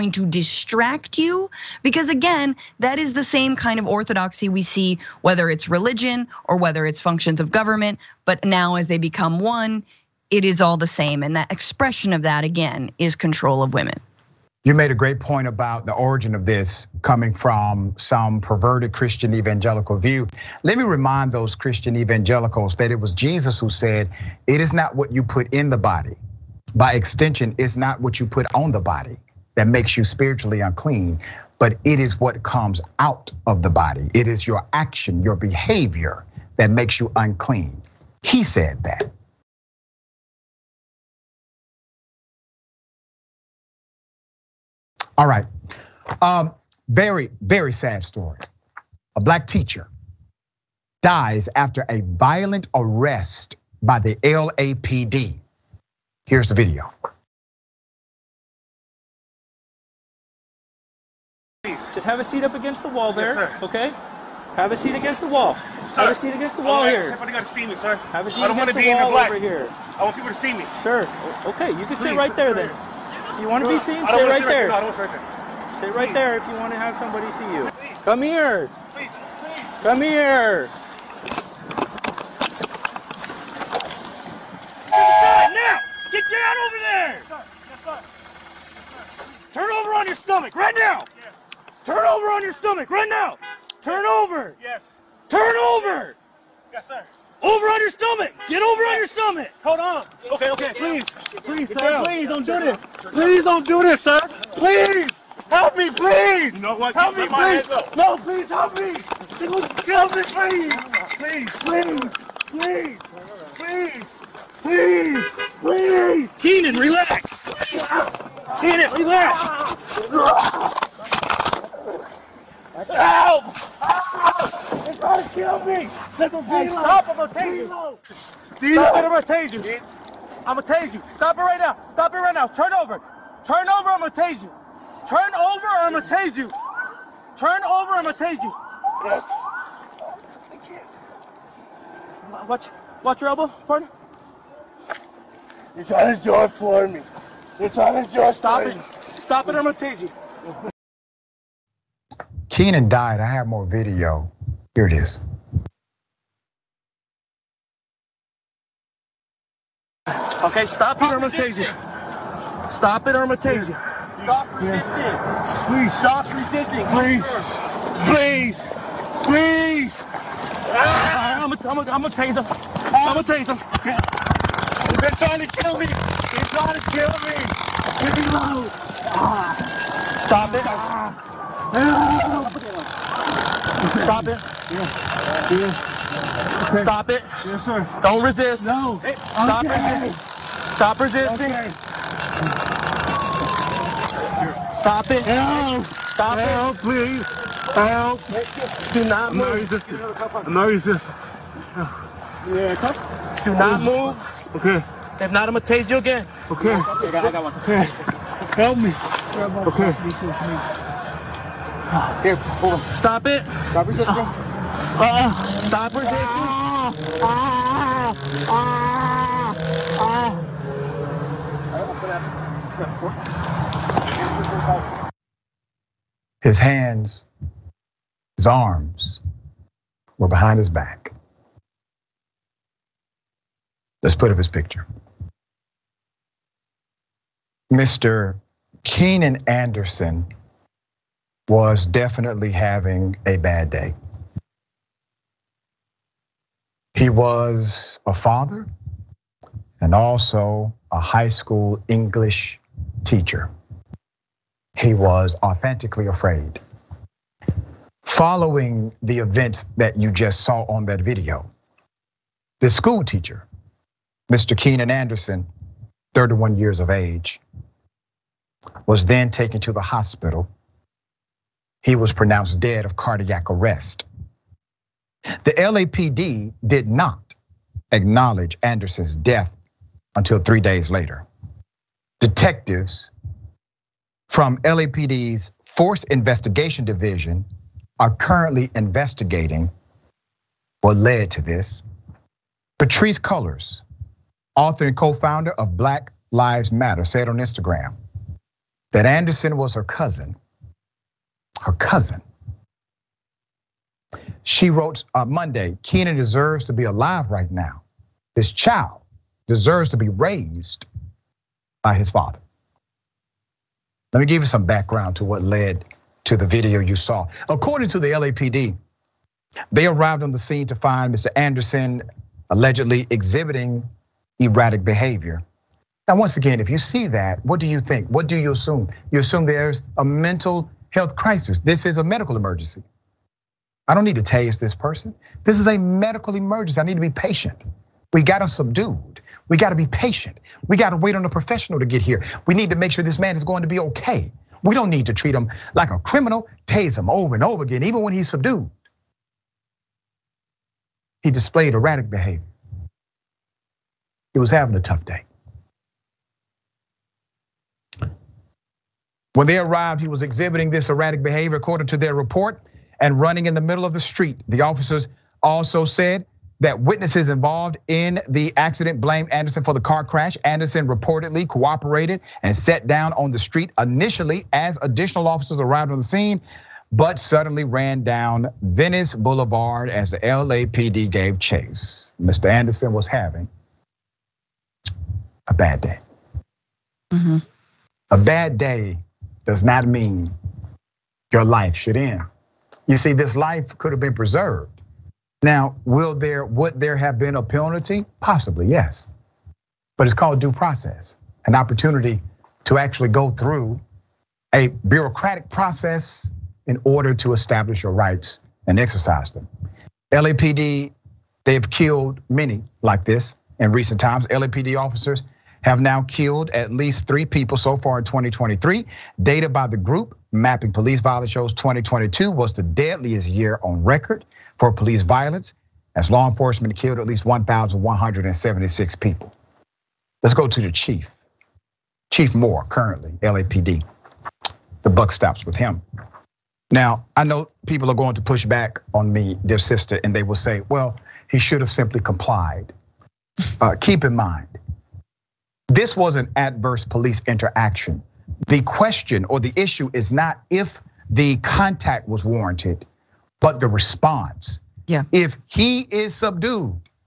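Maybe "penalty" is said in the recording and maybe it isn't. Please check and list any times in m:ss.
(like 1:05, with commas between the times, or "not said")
6:37.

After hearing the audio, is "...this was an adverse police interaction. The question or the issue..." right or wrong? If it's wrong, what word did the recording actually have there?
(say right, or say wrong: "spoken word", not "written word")
right.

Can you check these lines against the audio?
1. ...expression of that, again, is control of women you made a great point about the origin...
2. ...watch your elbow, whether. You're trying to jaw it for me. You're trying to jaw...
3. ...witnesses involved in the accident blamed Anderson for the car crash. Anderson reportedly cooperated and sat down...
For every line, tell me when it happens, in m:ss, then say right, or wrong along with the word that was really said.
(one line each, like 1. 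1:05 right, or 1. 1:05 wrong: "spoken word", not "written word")
1. 0:11 right
2. 2:23 wrong: "partner", not "whether"
3. 6:06 right.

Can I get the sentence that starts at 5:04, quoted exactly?
She wrote on uh, Monday, Keenan deserves to be alive right now.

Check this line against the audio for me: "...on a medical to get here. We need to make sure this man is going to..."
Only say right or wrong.
wrong.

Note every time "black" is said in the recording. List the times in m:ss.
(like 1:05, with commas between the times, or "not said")
0:49, 1:09, 4:55.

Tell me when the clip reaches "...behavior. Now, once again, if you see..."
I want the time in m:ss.
5:24.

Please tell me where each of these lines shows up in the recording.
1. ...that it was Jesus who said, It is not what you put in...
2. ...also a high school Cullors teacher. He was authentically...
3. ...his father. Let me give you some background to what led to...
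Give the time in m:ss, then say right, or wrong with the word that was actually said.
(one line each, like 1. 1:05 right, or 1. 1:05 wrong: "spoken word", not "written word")
1. 0:22 right
2. 4:09 wrong: "English", not "Cullors"
3. 5:11 right.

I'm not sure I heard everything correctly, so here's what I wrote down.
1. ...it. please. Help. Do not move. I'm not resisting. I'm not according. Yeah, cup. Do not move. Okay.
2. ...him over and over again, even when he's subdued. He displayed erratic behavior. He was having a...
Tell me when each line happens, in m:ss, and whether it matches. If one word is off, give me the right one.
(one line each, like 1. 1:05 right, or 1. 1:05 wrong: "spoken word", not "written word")
1. 3:16 wrong: "resisting", not "according"
2. 5:46 right.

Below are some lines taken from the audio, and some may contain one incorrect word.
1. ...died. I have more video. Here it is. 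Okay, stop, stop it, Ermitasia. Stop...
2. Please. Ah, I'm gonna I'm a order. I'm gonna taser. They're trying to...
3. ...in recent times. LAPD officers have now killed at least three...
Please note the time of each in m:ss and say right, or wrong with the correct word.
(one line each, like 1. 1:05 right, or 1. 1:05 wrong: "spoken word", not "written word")
1. 2:32 right
2. 2:49 wrong: "taser", not "order"
3. 6:53 right.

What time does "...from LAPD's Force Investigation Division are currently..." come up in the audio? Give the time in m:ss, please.
4:44.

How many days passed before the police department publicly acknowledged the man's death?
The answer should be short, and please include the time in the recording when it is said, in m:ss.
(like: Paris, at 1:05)
3, at 4:40.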